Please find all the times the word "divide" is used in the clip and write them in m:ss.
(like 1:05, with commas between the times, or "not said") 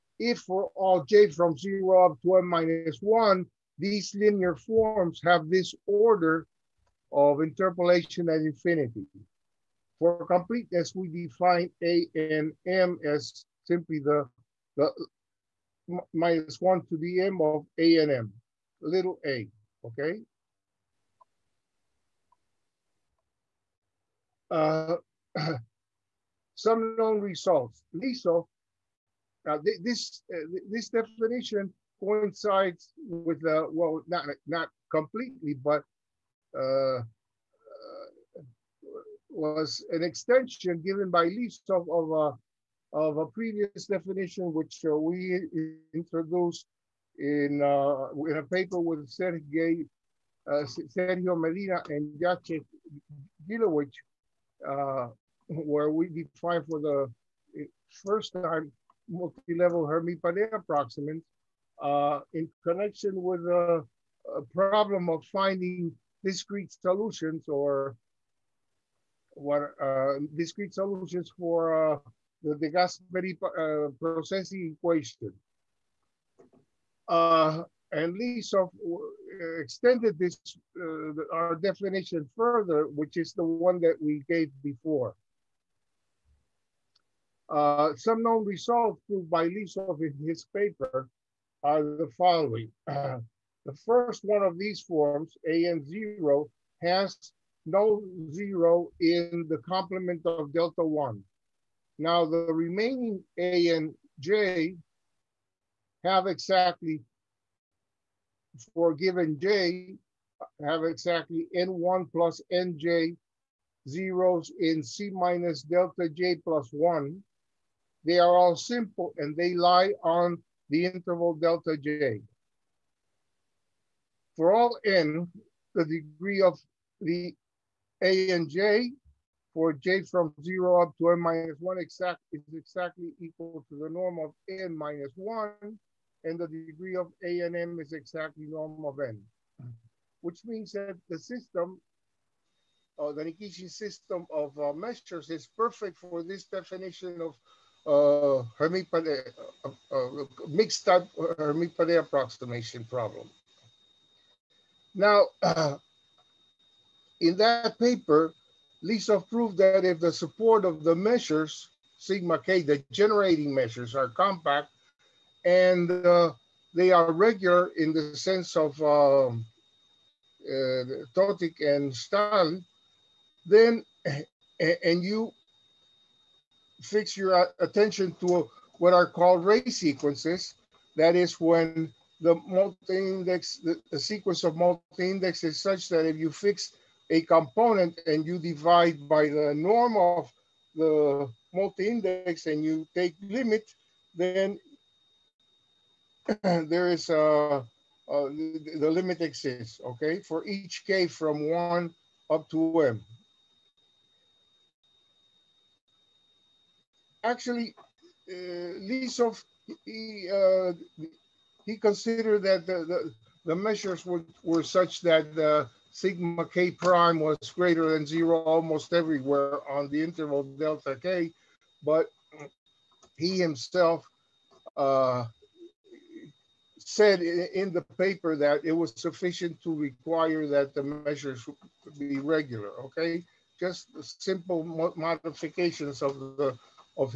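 3:08.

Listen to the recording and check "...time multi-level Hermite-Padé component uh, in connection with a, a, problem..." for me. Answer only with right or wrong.
wrong.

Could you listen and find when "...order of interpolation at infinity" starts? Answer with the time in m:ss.
0:05.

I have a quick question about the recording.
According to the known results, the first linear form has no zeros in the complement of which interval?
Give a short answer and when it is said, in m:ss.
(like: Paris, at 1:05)
Delta 1, at 1:40.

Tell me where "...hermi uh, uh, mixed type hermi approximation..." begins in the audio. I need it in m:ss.
2:28.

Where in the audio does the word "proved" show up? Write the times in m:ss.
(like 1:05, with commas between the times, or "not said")
1:29, 2:39.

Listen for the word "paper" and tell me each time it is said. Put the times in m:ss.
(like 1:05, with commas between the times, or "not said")
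0:48, 1:30, 2:37, 3:47.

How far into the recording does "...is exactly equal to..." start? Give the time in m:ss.
2:12.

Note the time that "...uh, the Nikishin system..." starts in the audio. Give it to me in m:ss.
2:22.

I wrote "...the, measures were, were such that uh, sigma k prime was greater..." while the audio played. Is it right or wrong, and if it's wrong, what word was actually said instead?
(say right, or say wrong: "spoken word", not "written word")
right.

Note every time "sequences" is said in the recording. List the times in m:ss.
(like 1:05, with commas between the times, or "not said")
2:59, 3:03.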